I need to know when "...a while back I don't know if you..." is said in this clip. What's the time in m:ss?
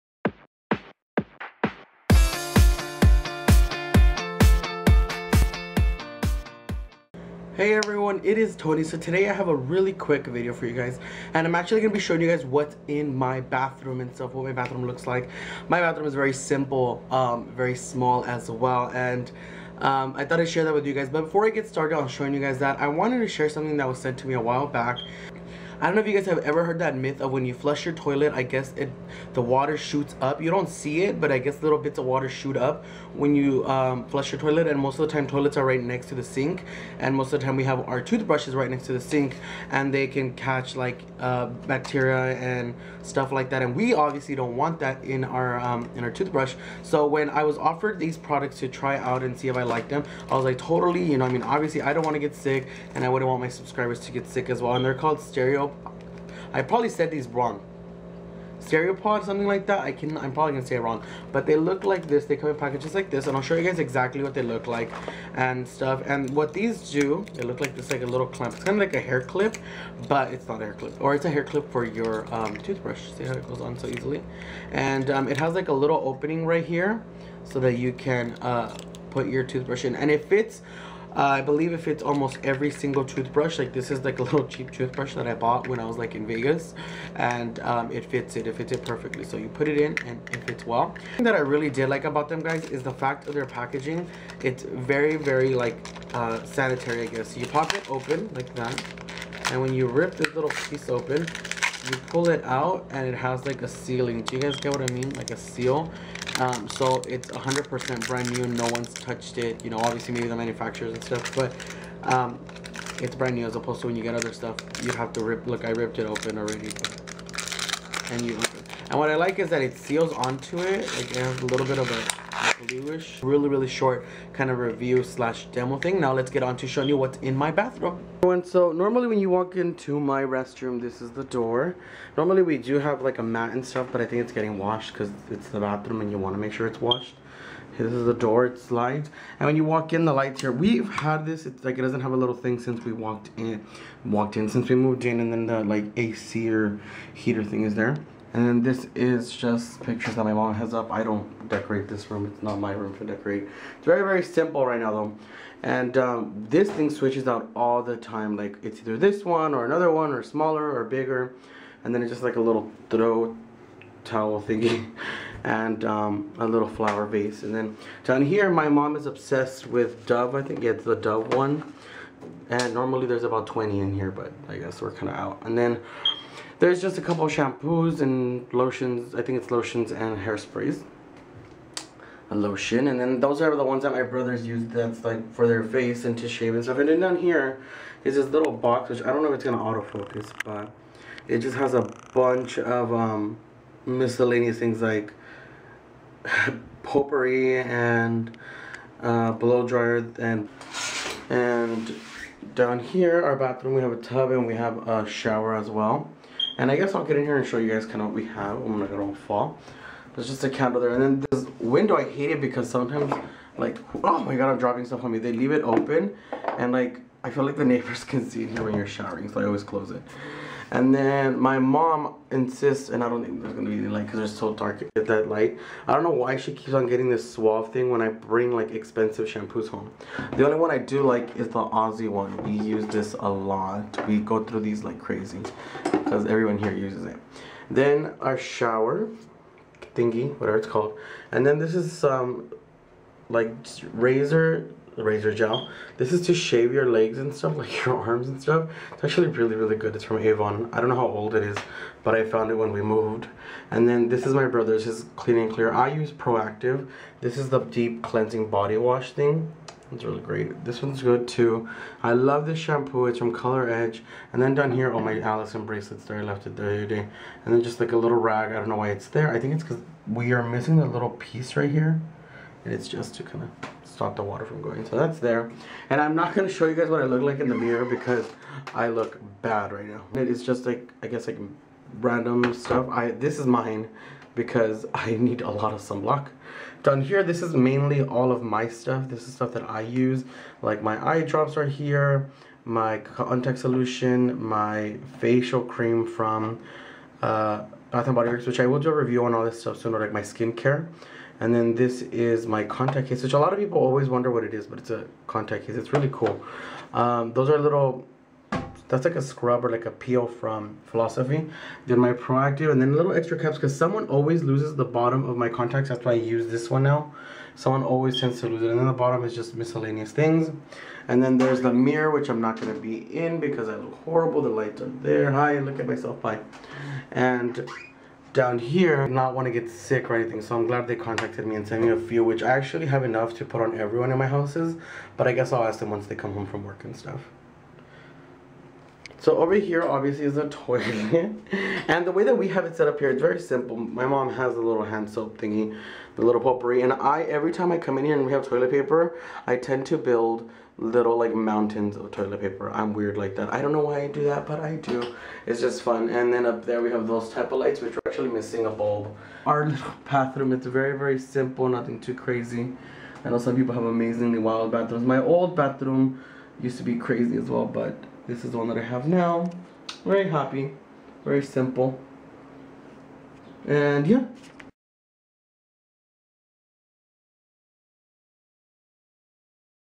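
0:24.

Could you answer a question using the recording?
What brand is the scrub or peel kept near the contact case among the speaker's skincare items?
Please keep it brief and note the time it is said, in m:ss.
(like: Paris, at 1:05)
Philosophy, at 5:10.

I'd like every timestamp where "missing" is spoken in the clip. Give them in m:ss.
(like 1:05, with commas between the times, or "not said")
4:30, 5:58.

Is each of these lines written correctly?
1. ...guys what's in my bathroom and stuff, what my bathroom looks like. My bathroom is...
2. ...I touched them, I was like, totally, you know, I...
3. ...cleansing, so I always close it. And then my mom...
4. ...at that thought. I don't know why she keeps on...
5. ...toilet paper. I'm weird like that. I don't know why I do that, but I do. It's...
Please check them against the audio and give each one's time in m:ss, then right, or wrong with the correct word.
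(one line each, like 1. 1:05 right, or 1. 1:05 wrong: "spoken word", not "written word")
1. 0:12 right
2. 0:49 wrong: "liked", not "touched"
3. 3:38 wrong: "showering", not "cleansing"
4. 3:44 wrong: "light", not "thought"
5. 5:52 right.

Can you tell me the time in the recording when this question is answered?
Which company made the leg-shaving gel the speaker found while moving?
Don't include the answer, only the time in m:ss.
4:10.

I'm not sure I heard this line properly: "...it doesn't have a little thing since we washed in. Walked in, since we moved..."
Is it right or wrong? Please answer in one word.
wrong.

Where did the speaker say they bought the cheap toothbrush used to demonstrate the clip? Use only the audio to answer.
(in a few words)
Vegas.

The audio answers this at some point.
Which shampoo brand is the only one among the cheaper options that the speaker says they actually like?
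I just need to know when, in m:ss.
3:51.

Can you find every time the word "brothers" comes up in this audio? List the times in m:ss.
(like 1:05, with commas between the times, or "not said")
3:04, 4:14.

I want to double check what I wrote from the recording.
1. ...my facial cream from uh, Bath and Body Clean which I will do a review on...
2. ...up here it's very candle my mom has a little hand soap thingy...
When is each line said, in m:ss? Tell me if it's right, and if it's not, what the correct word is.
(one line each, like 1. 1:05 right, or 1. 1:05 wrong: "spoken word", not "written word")
1. 4:54 wrong: "Works", not "Clean"
2. 5:42 wrong: "simple", not "candle".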